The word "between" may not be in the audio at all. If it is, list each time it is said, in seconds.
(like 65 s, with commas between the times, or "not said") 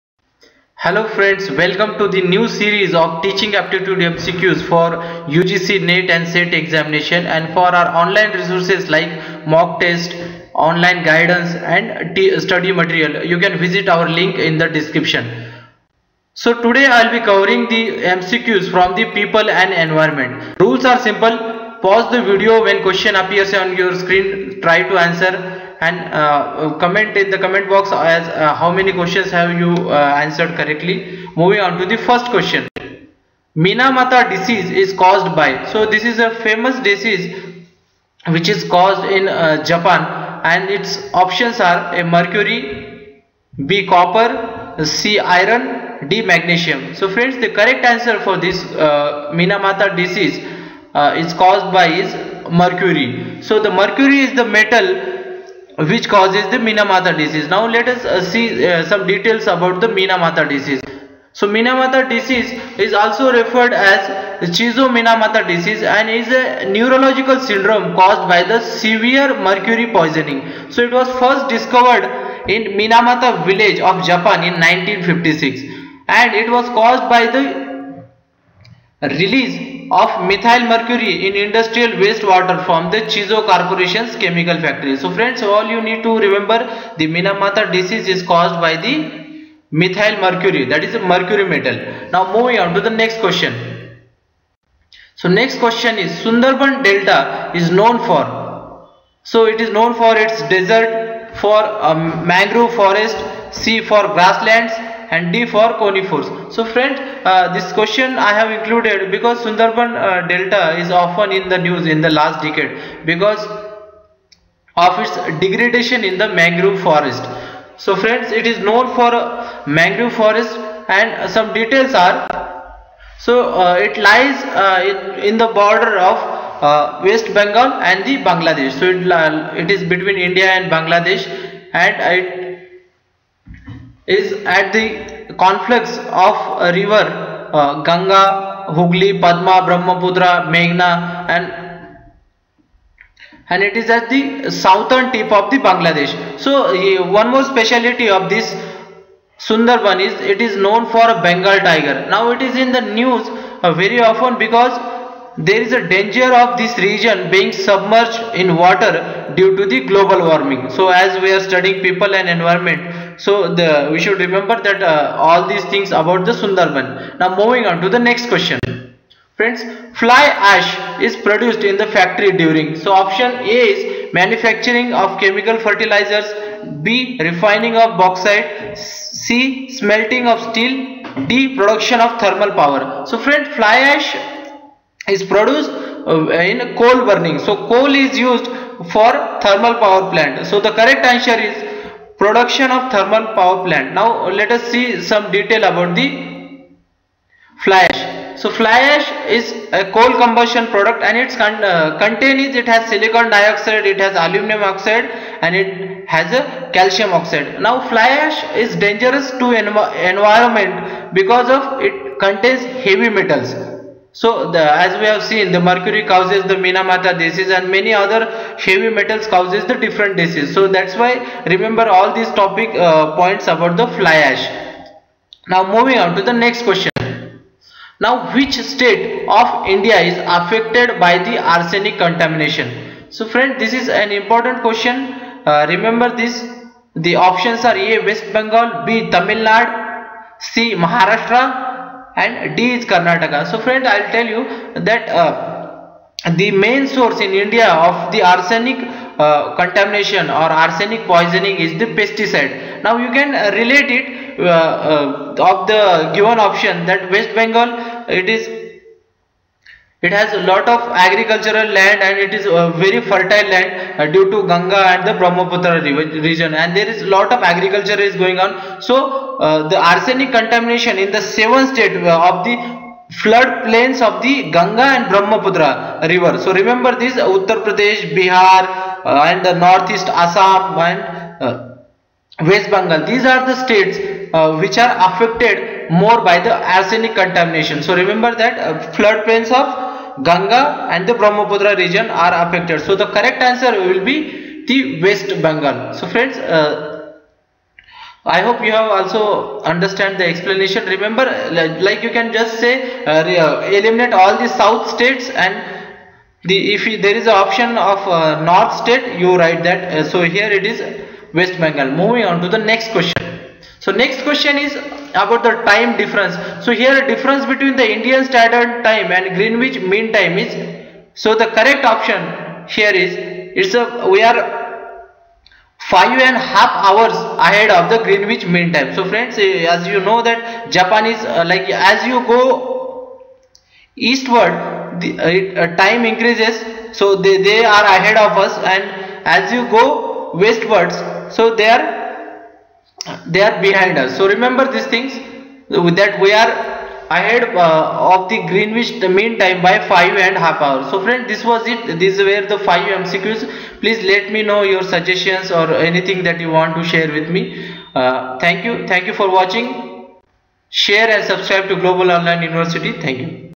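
129 s, 317 s.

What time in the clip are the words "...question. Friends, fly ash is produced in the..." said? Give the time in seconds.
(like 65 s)
168 s.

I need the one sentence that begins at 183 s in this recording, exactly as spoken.
So friend, fly ash is produced uh, in coal burning.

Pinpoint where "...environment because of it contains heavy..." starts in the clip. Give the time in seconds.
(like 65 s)
210 s.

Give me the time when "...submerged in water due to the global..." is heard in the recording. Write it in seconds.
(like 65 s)
157 s.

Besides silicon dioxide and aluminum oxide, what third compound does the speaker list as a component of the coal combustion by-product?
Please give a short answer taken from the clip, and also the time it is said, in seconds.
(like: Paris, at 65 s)
Calcium oxide, at 206 s.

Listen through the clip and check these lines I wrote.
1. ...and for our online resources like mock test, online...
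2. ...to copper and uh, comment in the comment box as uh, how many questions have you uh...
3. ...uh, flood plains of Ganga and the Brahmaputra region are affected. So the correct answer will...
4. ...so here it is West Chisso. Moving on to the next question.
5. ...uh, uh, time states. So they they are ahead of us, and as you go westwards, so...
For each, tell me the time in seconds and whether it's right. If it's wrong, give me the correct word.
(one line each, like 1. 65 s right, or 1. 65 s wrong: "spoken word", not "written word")
1. 7 s right
2. 24 s wrong: "answer", not "copper"
3. 288 s right
4. 310 s wrong: "Bengal", not "Chisso"
5. 335 s wrong: "increases", not "states".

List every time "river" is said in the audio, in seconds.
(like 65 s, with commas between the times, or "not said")
136 s, 276 s.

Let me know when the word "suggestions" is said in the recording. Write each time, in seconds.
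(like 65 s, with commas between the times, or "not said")
354 s.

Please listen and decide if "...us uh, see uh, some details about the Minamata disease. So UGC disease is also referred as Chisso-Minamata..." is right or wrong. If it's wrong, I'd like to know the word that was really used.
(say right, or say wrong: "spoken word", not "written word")
wrong: "Minamata", not "UGC".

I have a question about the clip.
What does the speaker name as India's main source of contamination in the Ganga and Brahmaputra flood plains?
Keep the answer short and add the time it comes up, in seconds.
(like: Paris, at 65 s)
Pesticide, at 251 s.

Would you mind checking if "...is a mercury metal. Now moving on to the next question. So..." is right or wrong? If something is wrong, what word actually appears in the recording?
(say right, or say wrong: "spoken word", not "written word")
right.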